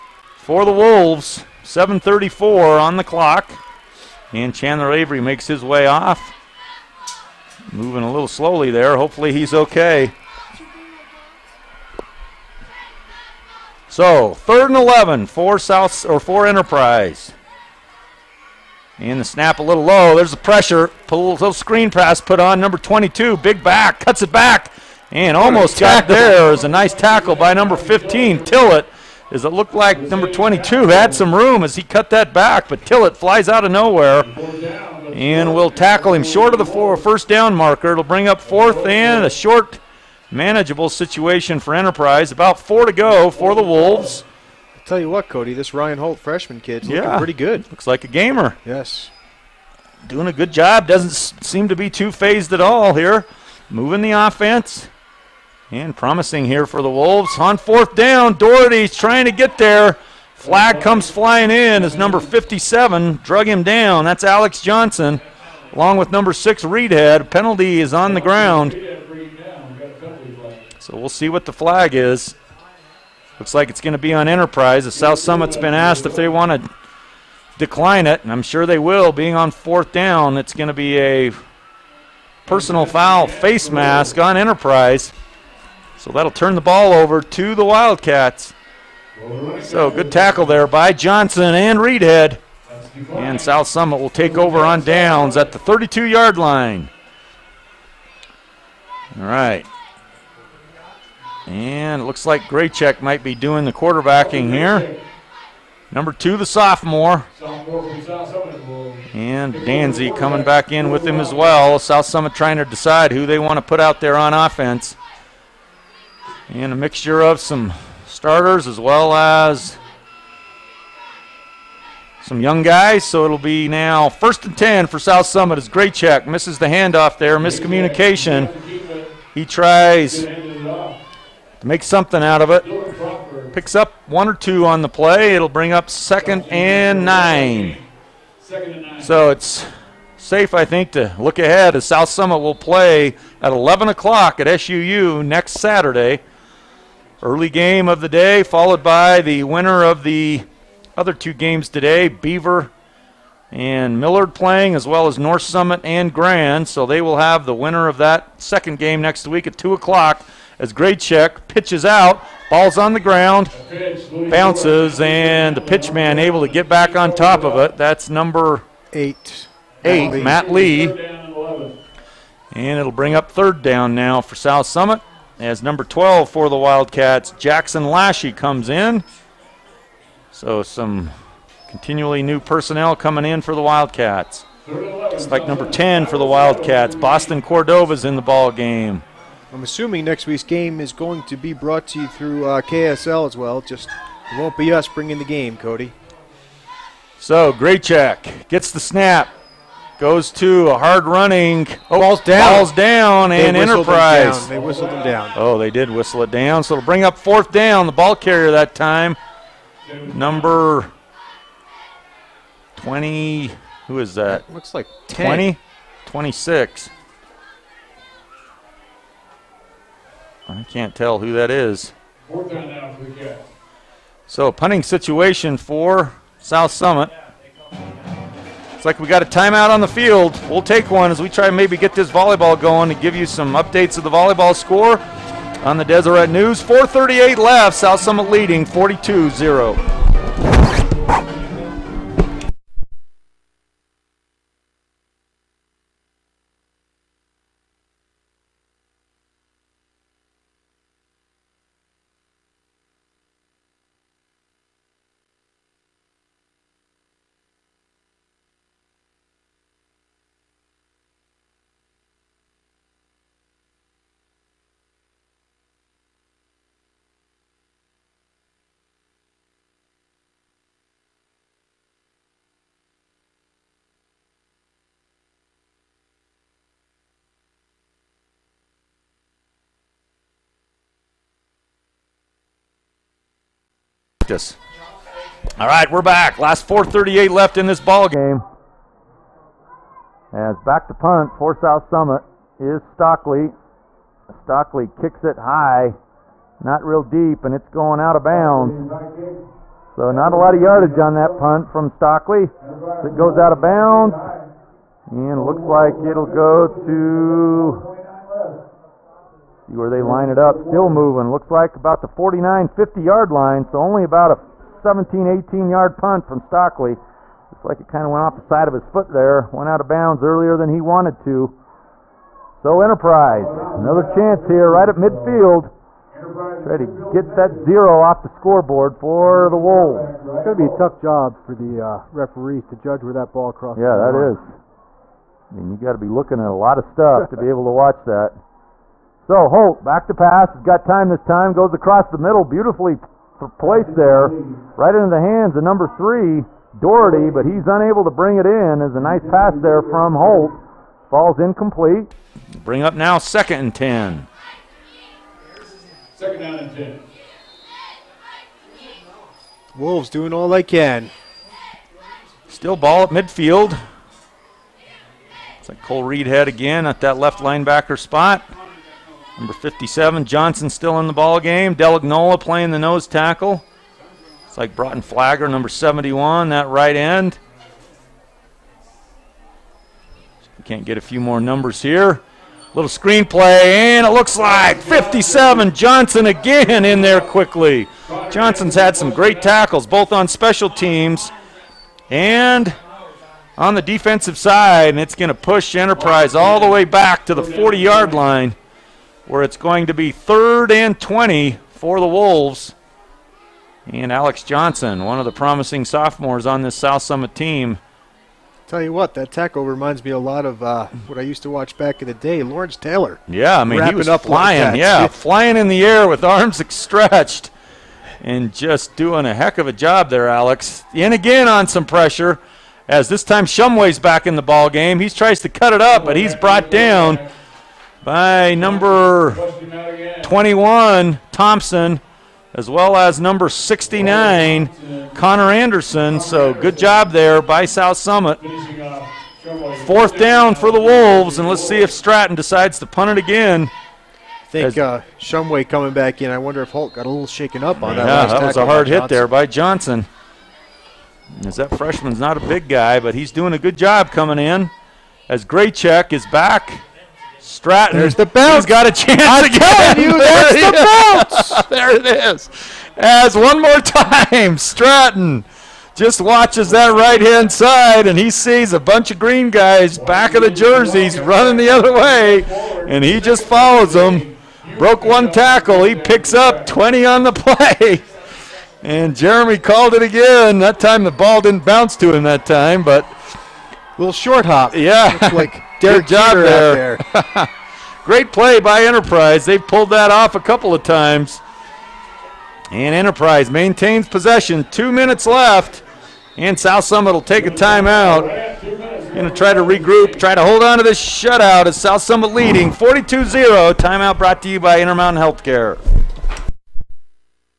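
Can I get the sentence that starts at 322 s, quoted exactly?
So Enterprise, another chance here right at midfield.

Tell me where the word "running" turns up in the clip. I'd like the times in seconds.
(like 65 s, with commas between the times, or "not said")
201 s, 471 s.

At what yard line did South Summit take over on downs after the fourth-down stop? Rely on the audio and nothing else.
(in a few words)
32.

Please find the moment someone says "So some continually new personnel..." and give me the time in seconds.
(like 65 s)
180 s.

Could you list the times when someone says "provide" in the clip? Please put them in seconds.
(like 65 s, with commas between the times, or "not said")
not said.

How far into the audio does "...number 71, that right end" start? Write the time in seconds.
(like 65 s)
375 s.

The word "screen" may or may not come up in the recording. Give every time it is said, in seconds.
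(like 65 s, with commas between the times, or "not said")
21 s, 382 s.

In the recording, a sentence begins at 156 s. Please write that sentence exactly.
So they will have the winner of that second game next week at 2 o'clock as Graycheck pitches out.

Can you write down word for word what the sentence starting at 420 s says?
In again on some pressure, as this time Shumway's back in the ball game.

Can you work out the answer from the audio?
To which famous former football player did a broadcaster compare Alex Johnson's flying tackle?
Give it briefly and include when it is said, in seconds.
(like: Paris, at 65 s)
Lawrence Taylor, at 412 s.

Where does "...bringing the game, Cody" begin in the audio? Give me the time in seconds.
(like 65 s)
194 s.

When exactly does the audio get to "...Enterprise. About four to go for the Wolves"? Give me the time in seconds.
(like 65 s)
41 s.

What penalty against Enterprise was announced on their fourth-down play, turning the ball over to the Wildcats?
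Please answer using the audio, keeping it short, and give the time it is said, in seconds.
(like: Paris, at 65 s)
Personal foul face mask, at 82 s.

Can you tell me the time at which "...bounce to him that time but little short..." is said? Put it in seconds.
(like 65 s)
481 s.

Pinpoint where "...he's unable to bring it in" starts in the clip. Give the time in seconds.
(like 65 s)
347 s.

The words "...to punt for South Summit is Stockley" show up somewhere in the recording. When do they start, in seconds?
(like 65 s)
290 s.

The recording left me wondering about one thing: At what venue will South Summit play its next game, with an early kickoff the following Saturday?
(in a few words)
SUU.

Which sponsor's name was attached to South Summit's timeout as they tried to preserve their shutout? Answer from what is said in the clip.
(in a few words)
Intermountain Healthcare.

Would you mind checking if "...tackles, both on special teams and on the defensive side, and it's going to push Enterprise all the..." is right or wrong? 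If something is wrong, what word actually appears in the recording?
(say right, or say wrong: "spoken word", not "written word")
right.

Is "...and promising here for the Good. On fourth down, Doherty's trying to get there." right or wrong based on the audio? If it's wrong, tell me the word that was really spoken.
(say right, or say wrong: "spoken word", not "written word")
wrong: "Wolves", not "Good".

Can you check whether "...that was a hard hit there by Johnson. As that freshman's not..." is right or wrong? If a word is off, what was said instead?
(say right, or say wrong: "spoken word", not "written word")
right.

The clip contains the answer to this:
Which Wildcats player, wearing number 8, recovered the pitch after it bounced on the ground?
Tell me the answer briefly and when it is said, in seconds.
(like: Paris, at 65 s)
Matt Lee, at 170 s.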